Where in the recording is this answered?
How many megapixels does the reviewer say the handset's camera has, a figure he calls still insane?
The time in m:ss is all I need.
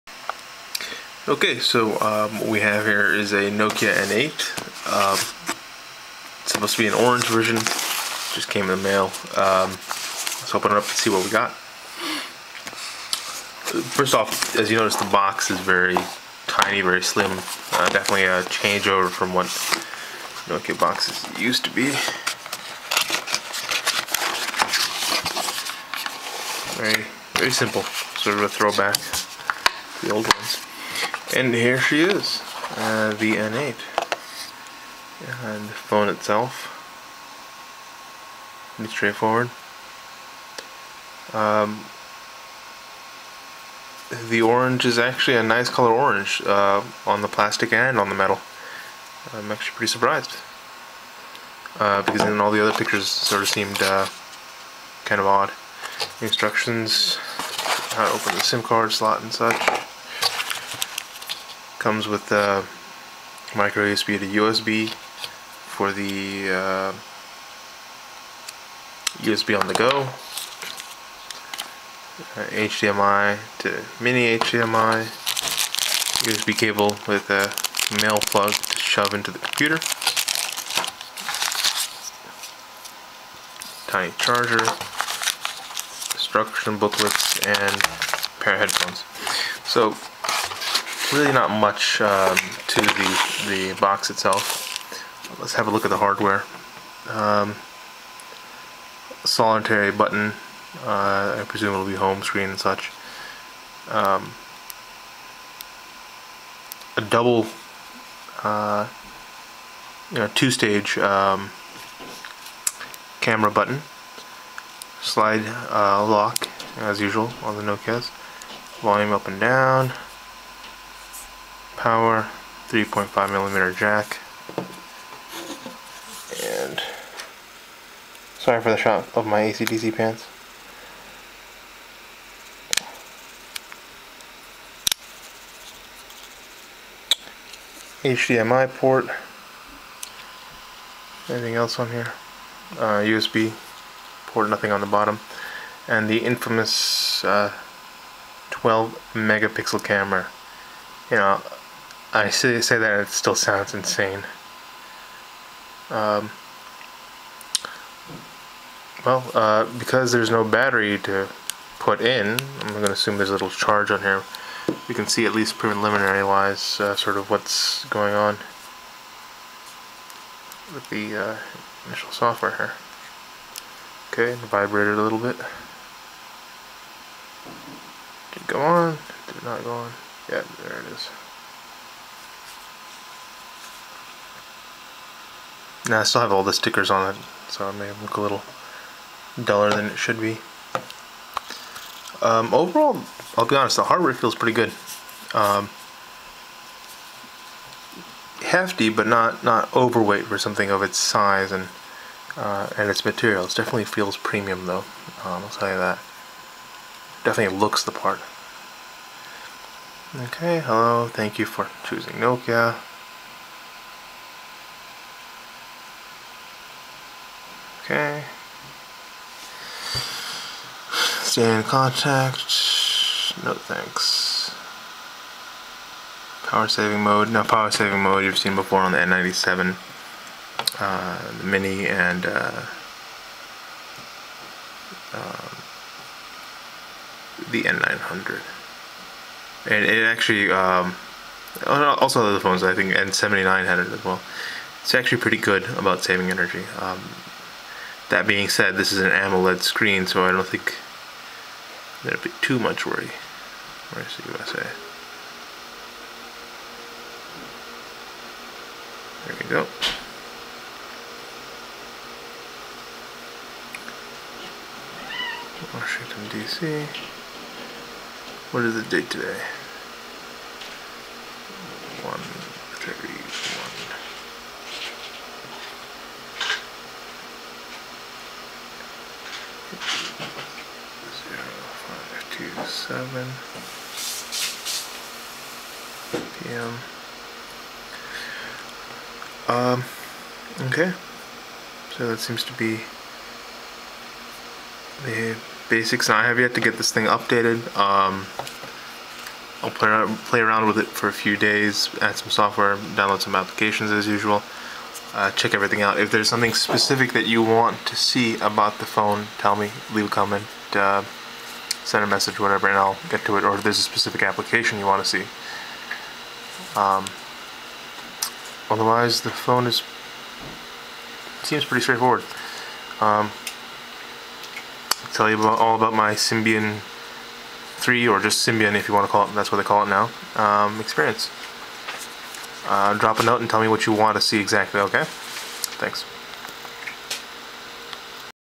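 2:28.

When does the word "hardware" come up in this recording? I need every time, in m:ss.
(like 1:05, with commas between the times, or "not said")
1:35, 3:13.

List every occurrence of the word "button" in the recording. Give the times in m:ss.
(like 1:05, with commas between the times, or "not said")
1:39, 1:53.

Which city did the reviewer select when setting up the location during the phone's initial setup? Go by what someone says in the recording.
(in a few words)
Washington, D.C.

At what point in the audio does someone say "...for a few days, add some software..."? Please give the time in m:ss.
5:00.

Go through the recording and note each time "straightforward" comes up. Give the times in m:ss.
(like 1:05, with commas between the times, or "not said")
0:38, 5:21.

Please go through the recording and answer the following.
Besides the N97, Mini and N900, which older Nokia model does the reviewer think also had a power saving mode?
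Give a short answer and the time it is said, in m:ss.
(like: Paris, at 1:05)
N79, at 4:02.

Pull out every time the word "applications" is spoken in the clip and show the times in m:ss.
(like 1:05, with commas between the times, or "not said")
5:03, 5:14.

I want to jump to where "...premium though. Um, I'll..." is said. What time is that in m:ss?
3:24.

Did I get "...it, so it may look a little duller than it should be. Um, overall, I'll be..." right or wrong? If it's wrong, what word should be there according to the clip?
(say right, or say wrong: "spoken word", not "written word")
right.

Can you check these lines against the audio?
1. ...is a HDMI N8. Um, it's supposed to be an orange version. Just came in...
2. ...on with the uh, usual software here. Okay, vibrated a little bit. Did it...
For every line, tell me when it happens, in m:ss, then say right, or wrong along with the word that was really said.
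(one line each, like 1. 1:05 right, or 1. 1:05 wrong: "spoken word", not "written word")
1. 0:03 wrong: "Nokia", not "HDMI"
2. 2:48 wrong: "initial", not "usual".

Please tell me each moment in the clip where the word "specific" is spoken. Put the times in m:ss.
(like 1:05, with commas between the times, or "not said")
5:06, 5:13.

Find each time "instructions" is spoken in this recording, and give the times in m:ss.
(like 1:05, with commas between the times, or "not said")
0:56, 1:26.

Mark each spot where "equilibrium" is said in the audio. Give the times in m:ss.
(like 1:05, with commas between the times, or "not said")
not said.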